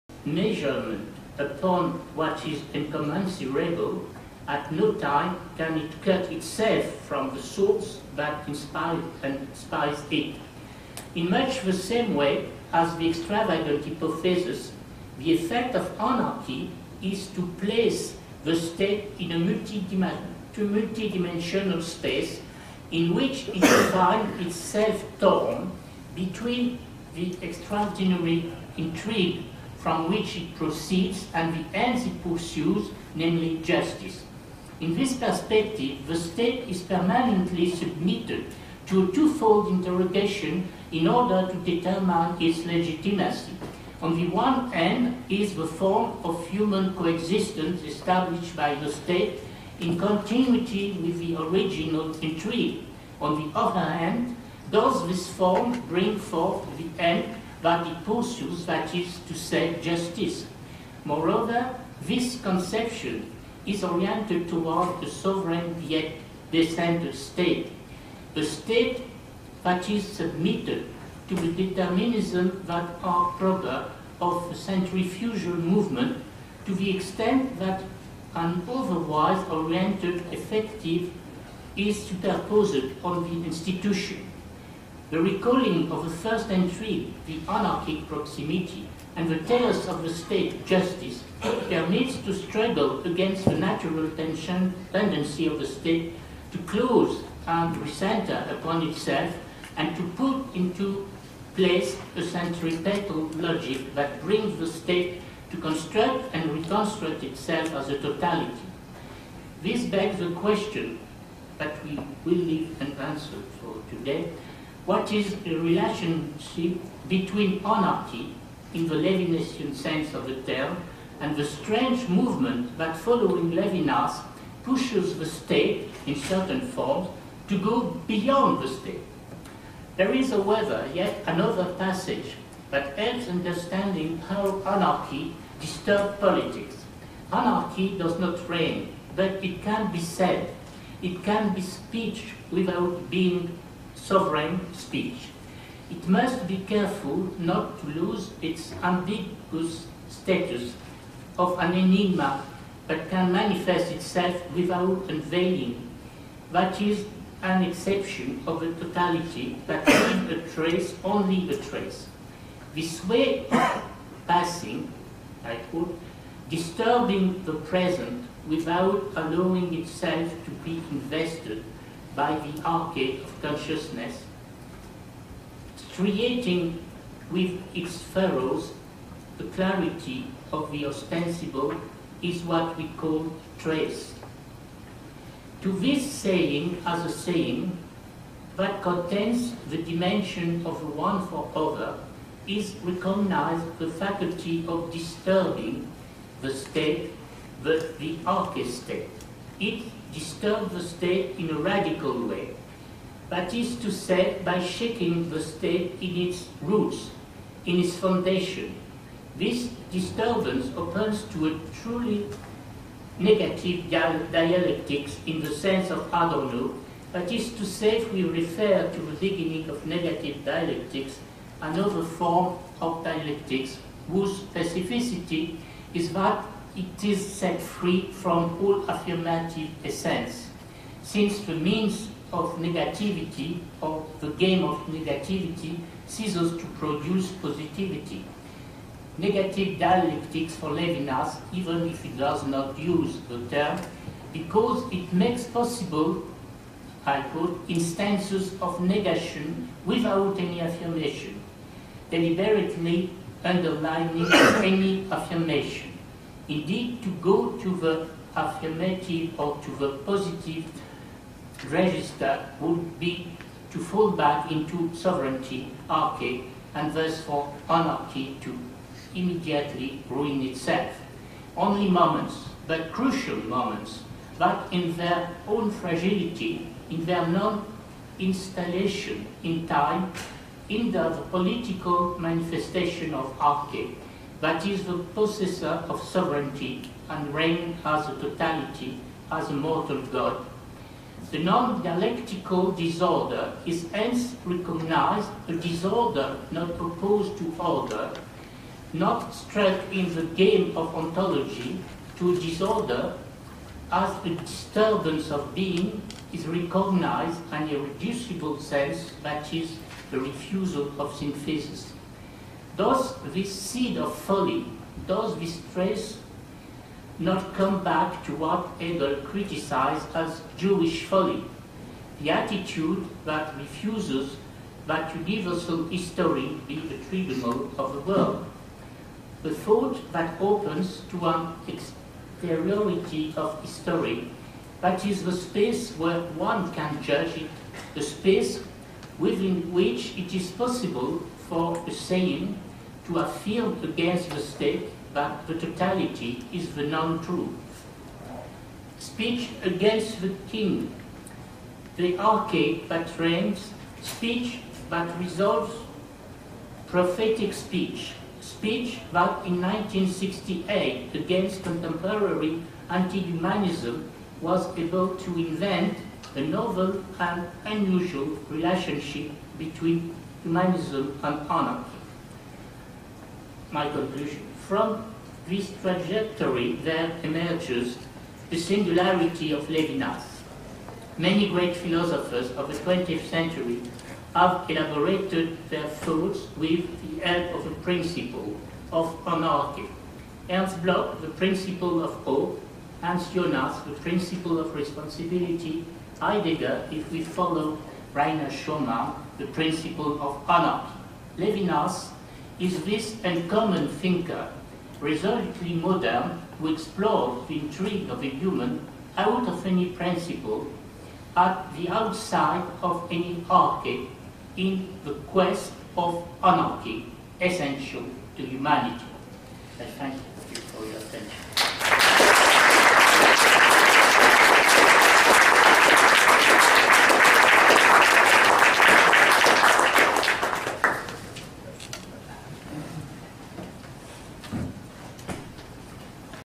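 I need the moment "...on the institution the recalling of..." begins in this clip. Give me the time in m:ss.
1:23.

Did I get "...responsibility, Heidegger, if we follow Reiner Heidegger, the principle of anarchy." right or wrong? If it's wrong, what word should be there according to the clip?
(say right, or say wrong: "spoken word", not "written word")
wrong: "Schürmann", not "Heidegger".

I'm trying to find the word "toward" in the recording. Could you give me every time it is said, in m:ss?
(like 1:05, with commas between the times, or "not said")
1:04.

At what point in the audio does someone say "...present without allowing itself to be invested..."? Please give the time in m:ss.
2:47.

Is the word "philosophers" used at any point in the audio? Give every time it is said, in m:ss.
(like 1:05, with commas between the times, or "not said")
6:21.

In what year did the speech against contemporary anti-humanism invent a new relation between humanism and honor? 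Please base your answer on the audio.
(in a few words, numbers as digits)
1968.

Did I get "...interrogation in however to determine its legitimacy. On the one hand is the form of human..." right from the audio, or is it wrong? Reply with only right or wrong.
wrong.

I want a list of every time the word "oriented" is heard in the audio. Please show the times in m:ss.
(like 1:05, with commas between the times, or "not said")
1:03, 1:19.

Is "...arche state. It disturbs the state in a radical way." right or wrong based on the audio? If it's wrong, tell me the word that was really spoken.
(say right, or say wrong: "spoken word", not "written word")
right.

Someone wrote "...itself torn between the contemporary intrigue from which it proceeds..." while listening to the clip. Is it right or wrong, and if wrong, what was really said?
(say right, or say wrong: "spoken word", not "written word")
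wrong: "extraordinary", not "contemporary".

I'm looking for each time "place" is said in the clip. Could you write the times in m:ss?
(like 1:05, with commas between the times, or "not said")
0:17, 1:41.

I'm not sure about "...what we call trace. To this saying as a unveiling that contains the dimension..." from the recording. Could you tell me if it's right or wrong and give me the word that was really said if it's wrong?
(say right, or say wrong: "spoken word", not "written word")
wrong: "saying", not "unveiling".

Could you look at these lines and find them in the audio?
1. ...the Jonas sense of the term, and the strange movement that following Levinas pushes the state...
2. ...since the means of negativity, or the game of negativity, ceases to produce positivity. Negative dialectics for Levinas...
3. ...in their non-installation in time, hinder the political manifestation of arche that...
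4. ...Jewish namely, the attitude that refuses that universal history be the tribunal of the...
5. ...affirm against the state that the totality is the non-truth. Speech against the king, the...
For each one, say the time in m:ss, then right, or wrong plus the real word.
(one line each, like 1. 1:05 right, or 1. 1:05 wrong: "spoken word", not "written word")
1. 1:58 wrong: "Levinasian", not "Jonas"
2. 3:51 right
3. 4:36 right
4. 5:20 wrong: "folly", not "namely"
5. 5:43 right.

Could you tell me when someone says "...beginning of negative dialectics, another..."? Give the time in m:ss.
3:39.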